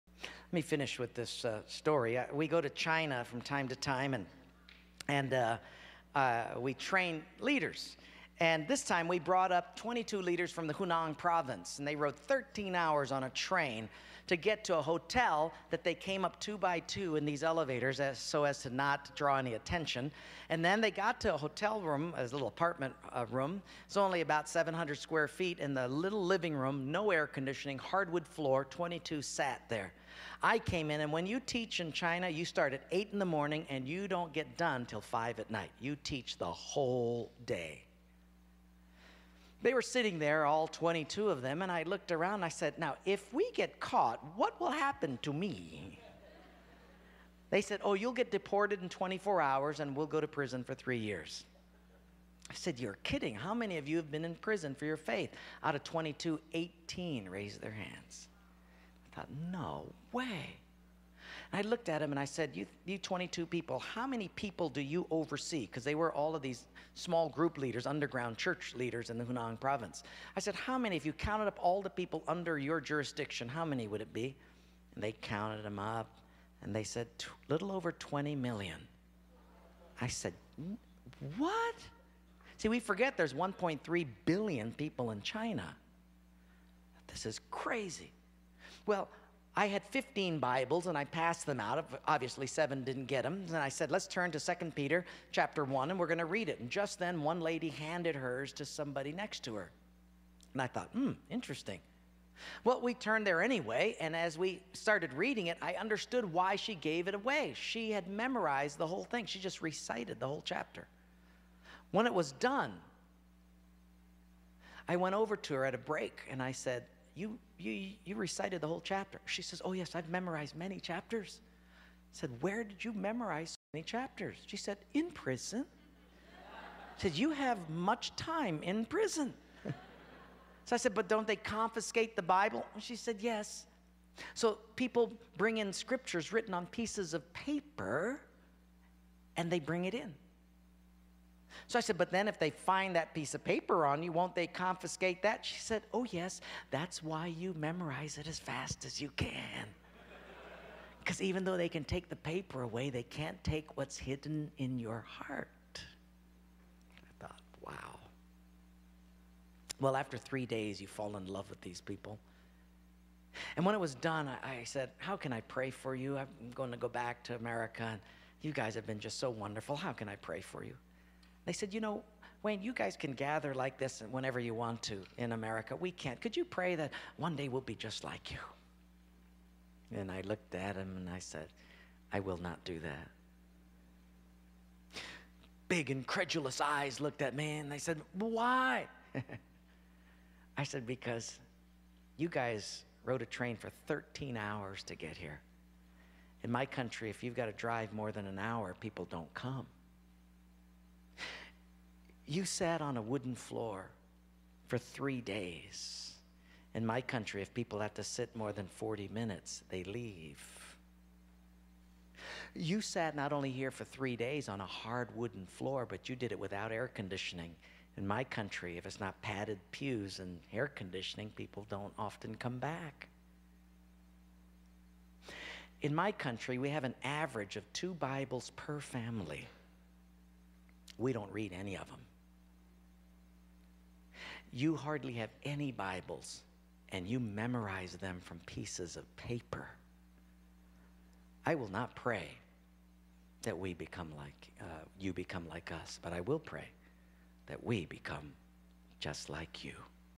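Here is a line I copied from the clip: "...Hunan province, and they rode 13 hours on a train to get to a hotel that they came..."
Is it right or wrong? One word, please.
right.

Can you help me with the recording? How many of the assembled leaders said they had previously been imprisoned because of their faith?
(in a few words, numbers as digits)
18.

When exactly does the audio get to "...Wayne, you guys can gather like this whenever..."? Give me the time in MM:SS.
02:52.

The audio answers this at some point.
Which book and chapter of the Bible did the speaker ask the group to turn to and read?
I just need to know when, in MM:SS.
01:34.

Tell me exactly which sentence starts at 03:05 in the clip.
Big, incredulous eyes looked at me and they said, Why?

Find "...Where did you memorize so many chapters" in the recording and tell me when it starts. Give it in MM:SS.
02:02.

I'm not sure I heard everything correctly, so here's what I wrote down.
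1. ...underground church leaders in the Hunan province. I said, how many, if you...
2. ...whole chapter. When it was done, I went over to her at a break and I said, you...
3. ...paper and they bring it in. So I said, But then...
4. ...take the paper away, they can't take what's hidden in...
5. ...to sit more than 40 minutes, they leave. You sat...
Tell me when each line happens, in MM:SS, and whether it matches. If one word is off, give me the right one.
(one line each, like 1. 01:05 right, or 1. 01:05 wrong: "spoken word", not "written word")
1. 01:07 right
2. 01:50 right
3. 02:17 right
4. 02:31 right
5. 03:27 right.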